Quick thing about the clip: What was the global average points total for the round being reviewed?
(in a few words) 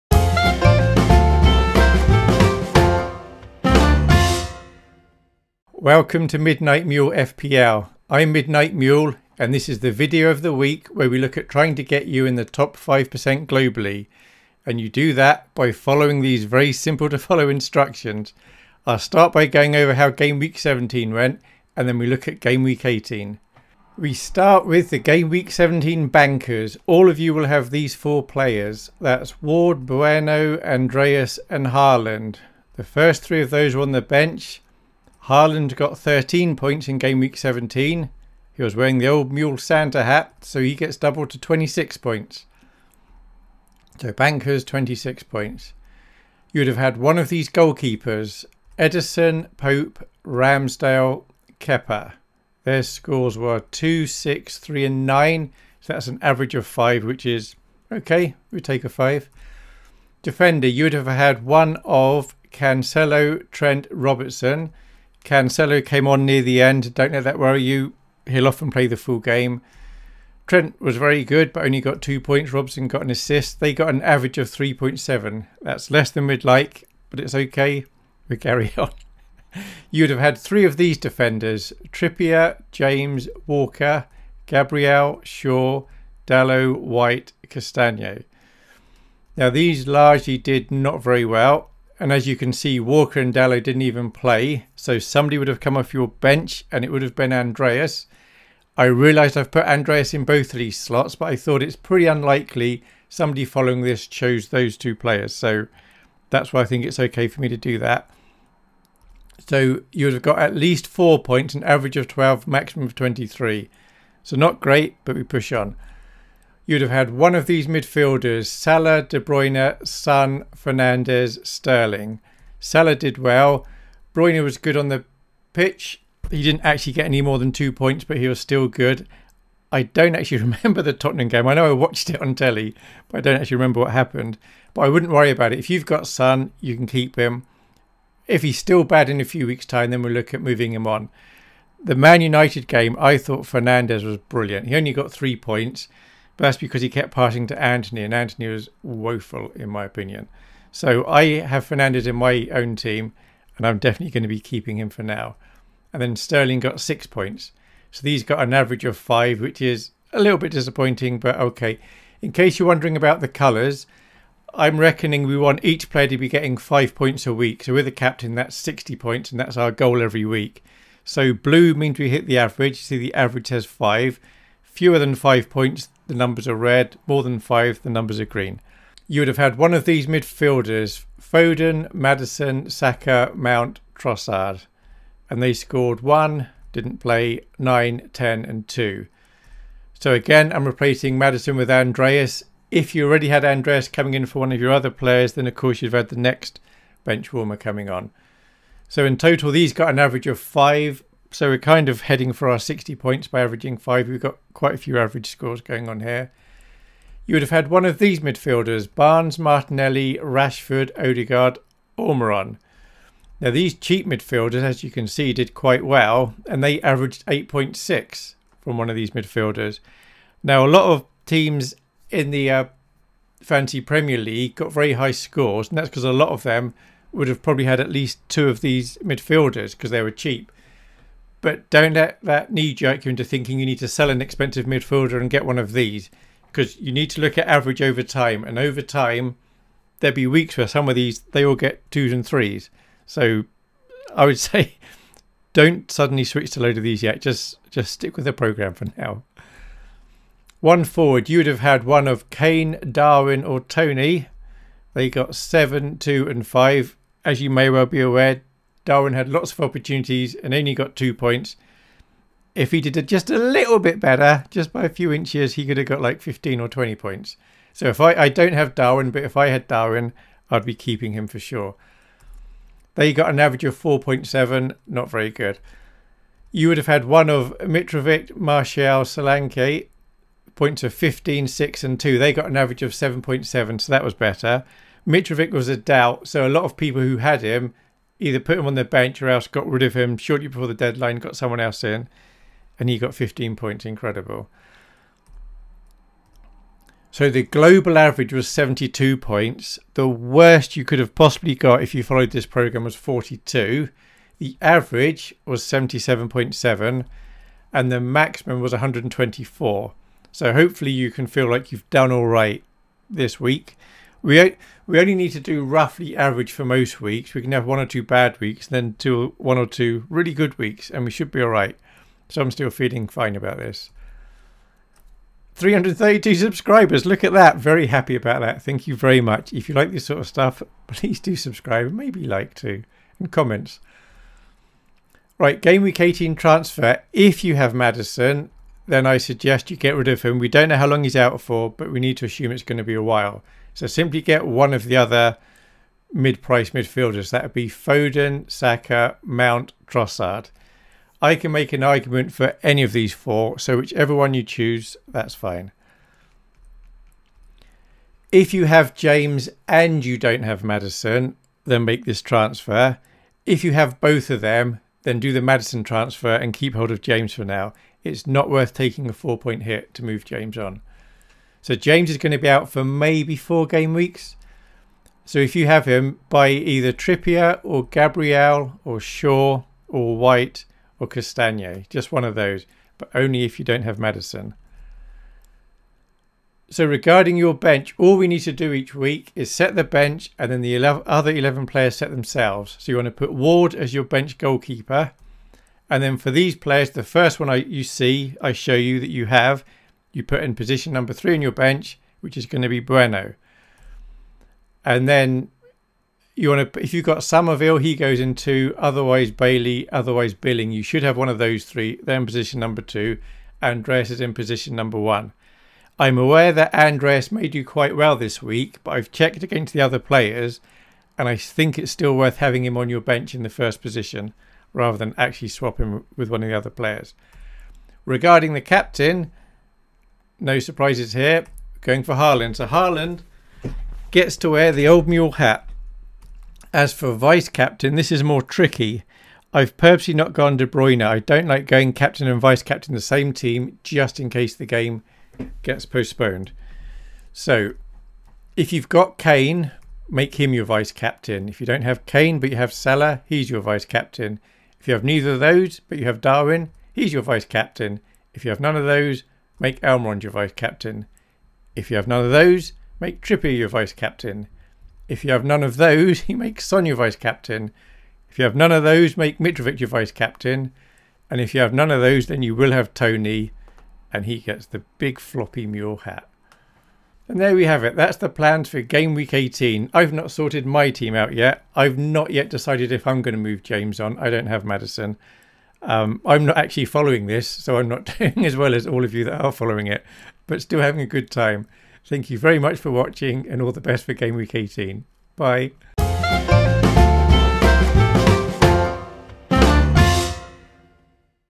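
72.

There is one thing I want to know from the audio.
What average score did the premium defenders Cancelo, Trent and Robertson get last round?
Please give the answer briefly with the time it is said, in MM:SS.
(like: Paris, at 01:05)
3.7, at 01:14.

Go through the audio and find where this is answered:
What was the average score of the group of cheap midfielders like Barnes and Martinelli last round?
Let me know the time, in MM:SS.
03:37.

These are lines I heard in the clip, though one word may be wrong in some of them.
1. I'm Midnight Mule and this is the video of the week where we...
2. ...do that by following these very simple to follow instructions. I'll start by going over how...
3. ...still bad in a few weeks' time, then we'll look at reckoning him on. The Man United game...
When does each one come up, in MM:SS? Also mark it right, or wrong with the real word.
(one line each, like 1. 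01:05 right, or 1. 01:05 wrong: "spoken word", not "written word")
1. 00:08 right
2. 00:14 right
3. 02:18 wrong: "moving", not "reckoning".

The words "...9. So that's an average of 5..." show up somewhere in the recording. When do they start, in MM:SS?
00:55.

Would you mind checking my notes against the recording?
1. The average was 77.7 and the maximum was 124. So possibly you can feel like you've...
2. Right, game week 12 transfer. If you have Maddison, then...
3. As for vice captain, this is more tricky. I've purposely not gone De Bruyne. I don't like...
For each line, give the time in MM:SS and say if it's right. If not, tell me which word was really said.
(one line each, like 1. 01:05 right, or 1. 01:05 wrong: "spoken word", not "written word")
1. 05:04 wrong: "hopefully", not "possibly"
2. 05:35 wrong: "18", not "12"
3. 07:16 right.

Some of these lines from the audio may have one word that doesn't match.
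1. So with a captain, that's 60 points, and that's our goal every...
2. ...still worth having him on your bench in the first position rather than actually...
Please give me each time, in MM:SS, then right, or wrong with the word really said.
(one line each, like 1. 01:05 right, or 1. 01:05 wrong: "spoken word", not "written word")
1. 02:47 right
2. 07:01 right.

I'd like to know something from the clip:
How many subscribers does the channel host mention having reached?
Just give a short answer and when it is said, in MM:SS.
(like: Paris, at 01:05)
332, at 05:25.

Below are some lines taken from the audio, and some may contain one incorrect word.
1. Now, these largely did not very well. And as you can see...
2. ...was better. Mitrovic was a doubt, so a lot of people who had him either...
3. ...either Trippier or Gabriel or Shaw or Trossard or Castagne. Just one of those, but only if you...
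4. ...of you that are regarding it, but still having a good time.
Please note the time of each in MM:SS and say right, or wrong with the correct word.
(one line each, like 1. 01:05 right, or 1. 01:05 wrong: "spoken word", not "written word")
1. 01:29 right
2. 04:44 right
3. 06:16 wrong: "White", not "Trossard"
4. 08:09 wrong: "following", not "regarding".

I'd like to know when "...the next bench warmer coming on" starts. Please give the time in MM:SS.
03:16.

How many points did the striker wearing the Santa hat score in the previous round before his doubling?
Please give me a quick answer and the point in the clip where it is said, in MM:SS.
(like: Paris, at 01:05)
13, at 00:35.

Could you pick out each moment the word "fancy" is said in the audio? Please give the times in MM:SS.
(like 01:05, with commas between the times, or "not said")
03:43.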